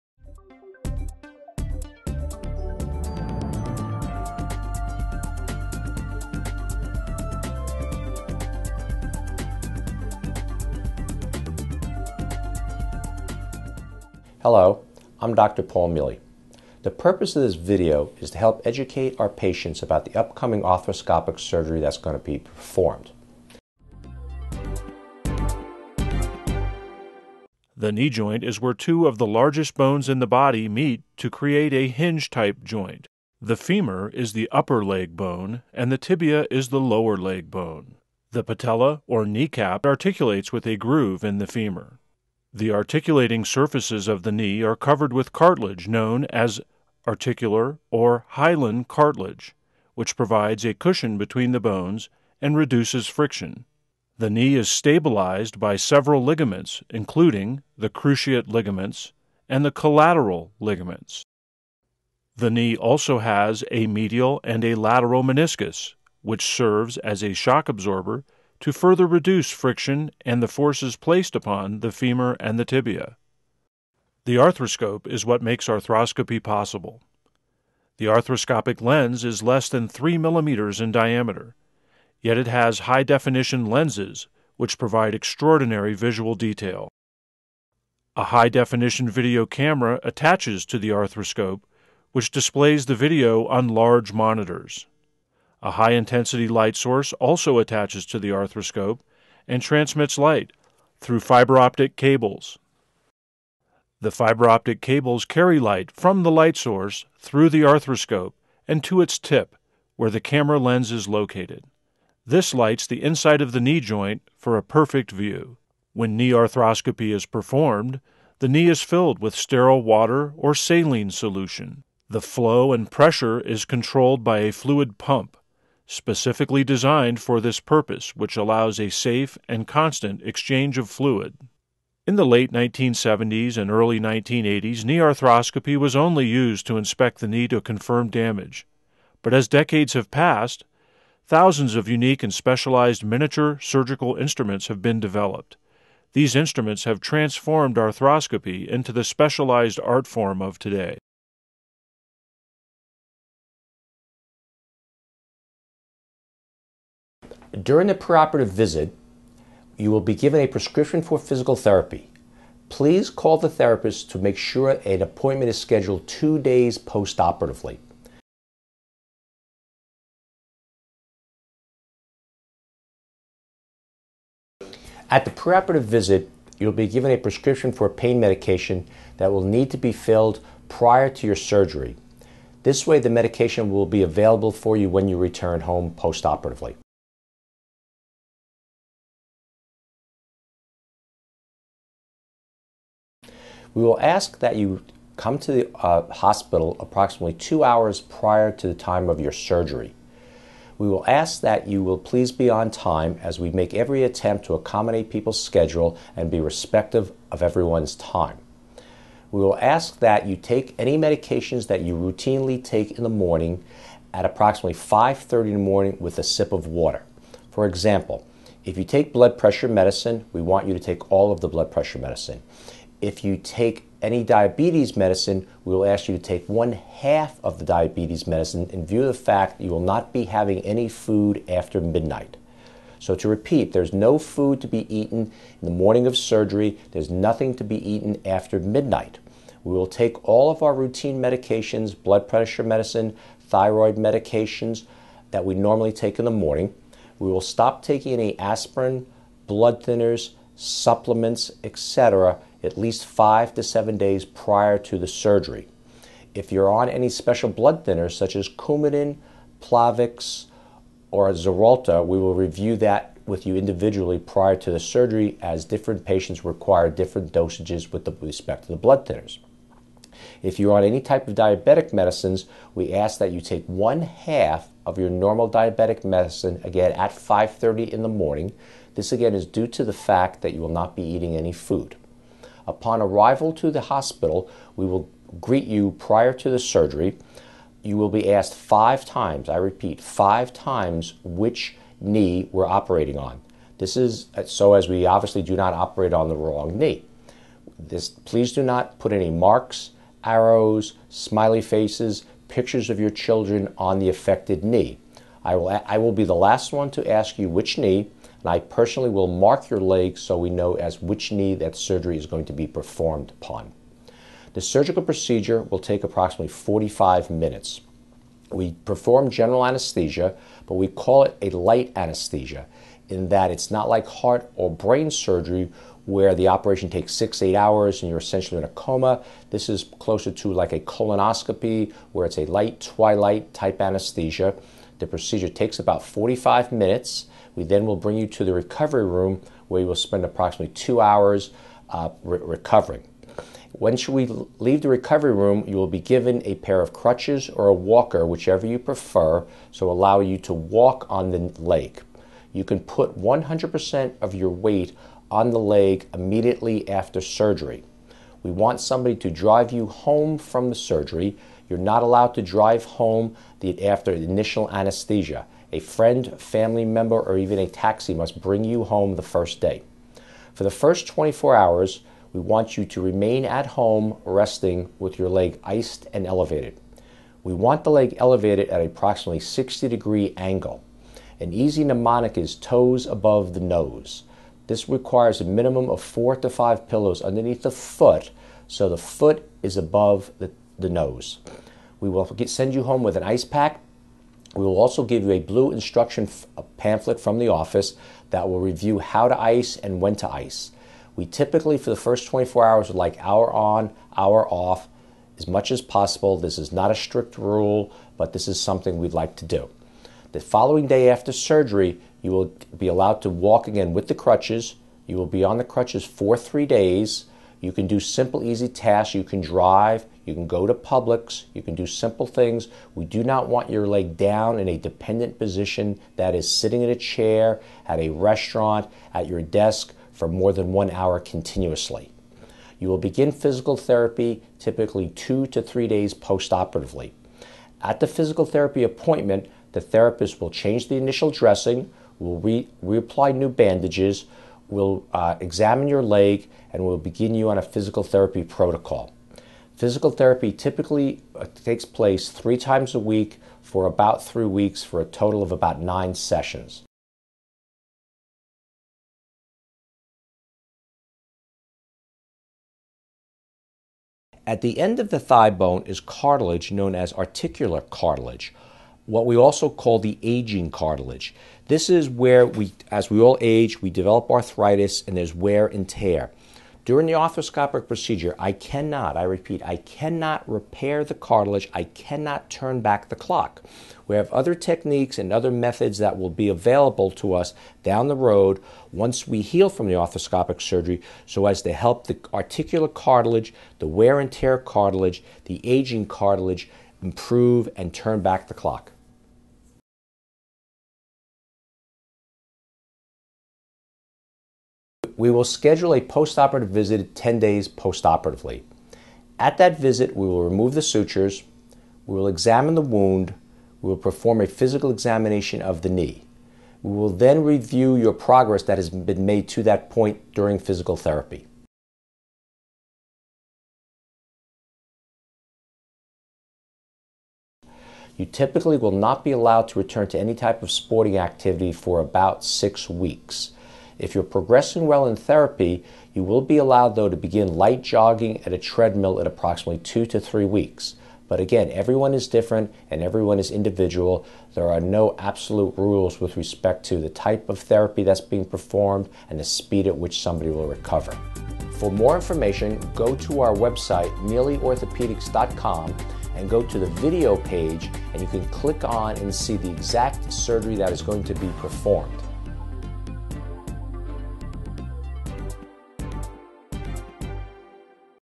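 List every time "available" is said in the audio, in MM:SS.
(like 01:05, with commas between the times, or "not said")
03:04, 08:06.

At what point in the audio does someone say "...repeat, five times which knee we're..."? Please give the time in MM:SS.
04:49.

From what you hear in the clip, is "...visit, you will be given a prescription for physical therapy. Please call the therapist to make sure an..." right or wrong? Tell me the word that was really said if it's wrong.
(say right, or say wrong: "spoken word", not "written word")
right.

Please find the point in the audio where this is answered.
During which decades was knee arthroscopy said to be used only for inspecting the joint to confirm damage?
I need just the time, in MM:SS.
02:12.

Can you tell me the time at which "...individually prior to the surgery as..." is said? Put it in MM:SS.
04:23.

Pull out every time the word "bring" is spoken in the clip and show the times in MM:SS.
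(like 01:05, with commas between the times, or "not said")
05:37, 06:08.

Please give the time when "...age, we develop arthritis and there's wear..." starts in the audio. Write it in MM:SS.
07:53.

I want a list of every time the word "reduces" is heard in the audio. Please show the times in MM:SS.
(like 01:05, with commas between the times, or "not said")
00:52, 01:09.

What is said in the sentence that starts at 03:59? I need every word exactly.
We will take all of our routine medications, blood pressure medicine, thyroid medications that we normally take in the morning.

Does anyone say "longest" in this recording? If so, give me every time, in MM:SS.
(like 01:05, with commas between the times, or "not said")
not said.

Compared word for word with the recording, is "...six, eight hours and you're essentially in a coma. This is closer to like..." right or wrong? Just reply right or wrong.
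right.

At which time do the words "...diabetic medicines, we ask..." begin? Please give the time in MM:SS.
04:31.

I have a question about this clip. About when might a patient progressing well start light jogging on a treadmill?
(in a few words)
2 to 3 weeks.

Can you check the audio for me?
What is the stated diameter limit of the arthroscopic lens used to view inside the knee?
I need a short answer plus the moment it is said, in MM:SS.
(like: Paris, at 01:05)
3 millimeters, at 01:19.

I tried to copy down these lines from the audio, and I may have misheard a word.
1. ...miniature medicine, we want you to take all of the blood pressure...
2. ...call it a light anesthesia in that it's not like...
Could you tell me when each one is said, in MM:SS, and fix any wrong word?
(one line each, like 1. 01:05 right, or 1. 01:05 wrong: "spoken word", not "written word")
1. 03:39 wrong: "pressure", not "miniature"
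2. 05:20 right.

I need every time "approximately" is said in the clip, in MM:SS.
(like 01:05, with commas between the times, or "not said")
03:16, 03:34, 05:16, 05:40, 06:18, 08:59.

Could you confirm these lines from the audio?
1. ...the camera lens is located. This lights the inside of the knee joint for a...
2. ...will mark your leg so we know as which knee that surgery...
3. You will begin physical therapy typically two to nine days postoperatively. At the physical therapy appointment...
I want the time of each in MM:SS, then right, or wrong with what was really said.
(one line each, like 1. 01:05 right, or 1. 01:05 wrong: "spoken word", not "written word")
1. 01:50 right
2. 05:09 right
3. 07:12 wrong: "three", not "nine".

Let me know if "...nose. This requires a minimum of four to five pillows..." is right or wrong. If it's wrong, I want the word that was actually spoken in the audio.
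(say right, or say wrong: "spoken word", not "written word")
right.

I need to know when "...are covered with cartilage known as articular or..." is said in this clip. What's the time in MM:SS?
00:44.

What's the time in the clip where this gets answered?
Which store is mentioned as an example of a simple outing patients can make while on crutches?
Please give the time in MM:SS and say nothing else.
07:00.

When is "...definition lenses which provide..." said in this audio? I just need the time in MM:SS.
01:23.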